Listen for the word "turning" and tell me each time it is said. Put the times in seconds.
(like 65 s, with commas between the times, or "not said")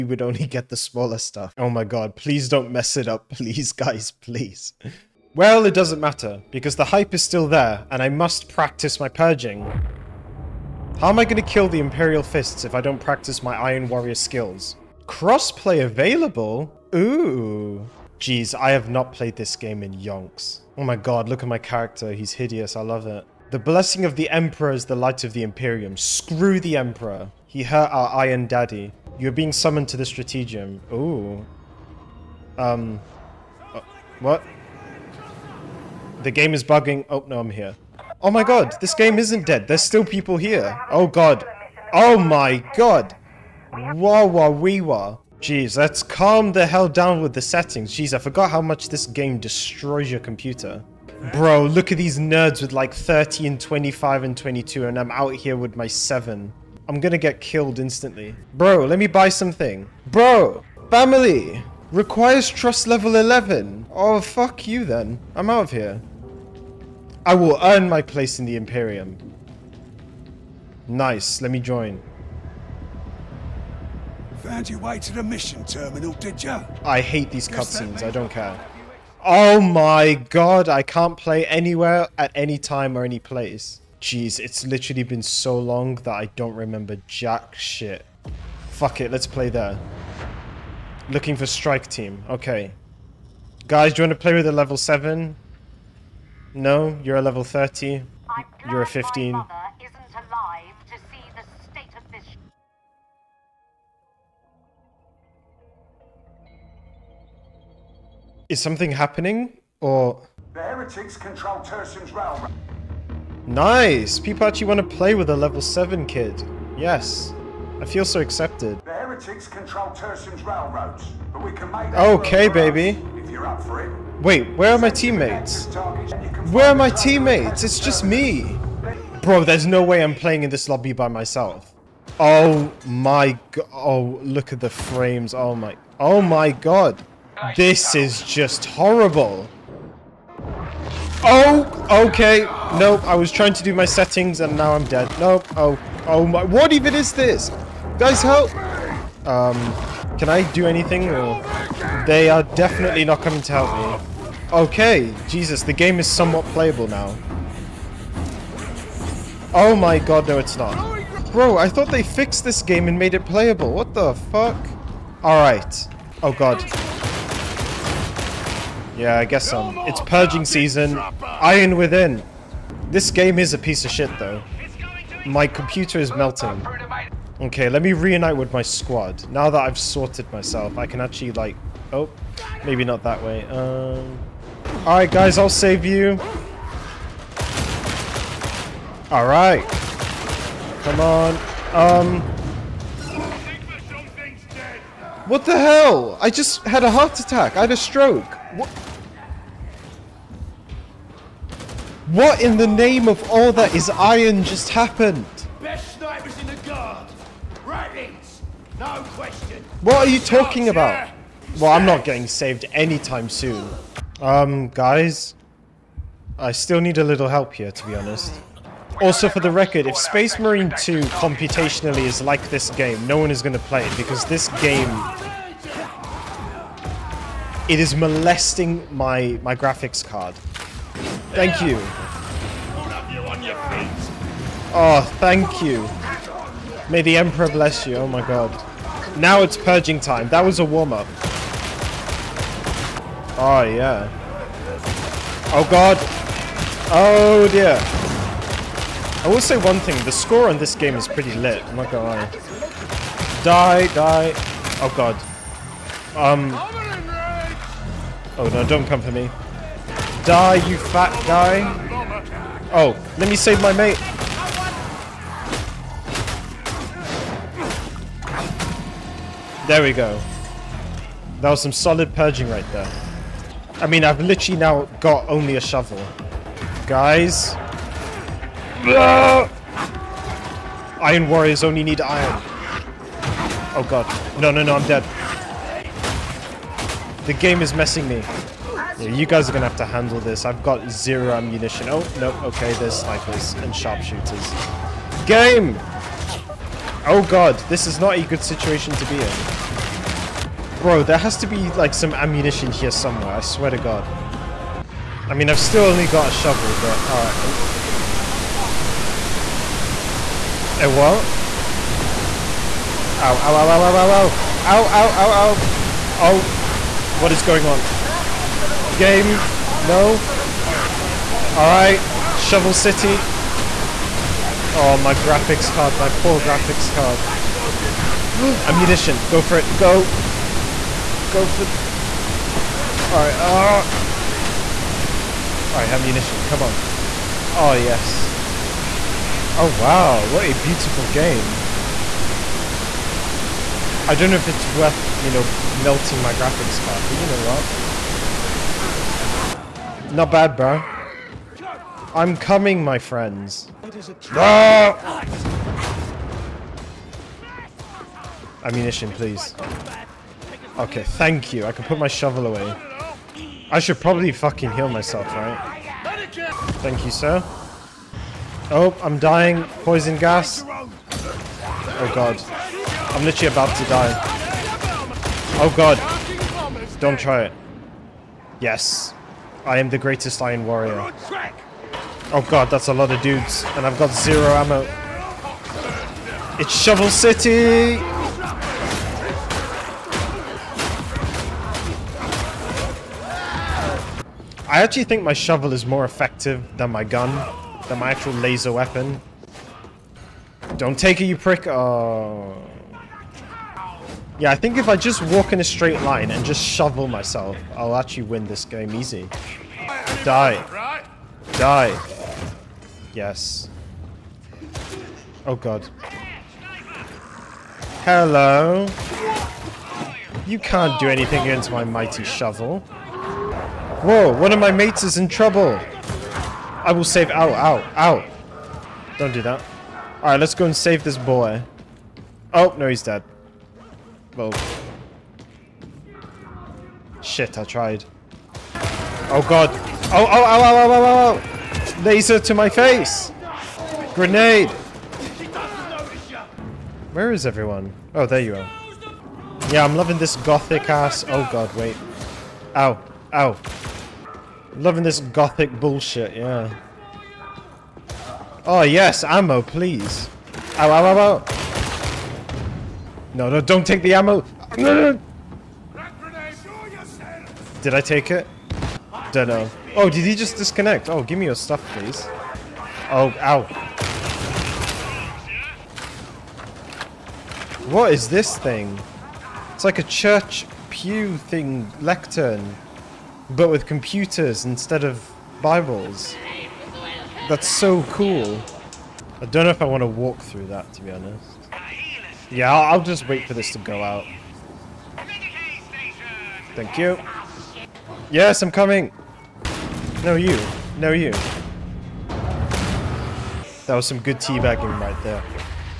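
not said.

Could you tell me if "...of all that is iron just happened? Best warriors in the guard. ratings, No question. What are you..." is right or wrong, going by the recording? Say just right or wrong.
wrong.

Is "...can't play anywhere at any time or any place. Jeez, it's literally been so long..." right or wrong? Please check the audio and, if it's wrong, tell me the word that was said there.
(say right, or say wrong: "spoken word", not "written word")
right.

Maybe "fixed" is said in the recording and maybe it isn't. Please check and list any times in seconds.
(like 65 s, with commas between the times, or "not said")
162 s.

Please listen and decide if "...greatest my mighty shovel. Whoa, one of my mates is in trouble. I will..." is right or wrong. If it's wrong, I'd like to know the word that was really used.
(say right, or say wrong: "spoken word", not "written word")
wrong: "against", not "greatest".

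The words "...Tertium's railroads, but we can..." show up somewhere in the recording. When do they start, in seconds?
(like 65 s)
119 s.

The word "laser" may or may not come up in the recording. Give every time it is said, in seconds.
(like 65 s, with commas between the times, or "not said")
398 s, 442 s.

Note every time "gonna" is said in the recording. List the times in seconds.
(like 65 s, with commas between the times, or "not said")
56 s, 251 s.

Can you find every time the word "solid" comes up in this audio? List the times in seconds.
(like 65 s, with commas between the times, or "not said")
271 s.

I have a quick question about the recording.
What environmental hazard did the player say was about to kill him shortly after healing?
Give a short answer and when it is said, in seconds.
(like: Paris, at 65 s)
Poison gas, at 369 s.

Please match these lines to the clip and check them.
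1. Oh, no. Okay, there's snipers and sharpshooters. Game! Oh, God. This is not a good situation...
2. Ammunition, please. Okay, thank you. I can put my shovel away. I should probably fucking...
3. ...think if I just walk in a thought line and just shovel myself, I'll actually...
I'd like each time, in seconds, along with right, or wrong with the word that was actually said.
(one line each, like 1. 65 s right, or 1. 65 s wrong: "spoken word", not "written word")
1. 291 s right
2. 358 s right
3. 404 s wrong: "straight", not "thought".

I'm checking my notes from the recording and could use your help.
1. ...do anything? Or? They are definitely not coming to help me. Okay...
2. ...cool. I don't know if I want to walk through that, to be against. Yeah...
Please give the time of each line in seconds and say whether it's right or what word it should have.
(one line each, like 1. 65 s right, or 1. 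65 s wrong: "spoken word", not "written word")
1. 150 s right
2. 488 s wrong: "honest", not "against".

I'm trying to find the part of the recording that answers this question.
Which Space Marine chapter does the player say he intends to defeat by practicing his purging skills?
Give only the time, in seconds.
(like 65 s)
11 s.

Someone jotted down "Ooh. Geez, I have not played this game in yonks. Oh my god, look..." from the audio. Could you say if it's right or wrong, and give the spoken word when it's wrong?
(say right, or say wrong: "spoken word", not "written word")
right.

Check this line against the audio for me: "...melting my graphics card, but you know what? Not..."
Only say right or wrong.
right.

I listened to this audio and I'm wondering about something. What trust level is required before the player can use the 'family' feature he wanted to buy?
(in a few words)
11.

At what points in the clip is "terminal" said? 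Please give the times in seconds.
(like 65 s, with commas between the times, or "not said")
75 s.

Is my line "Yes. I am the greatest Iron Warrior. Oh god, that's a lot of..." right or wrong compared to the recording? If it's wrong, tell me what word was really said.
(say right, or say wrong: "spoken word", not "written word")
right.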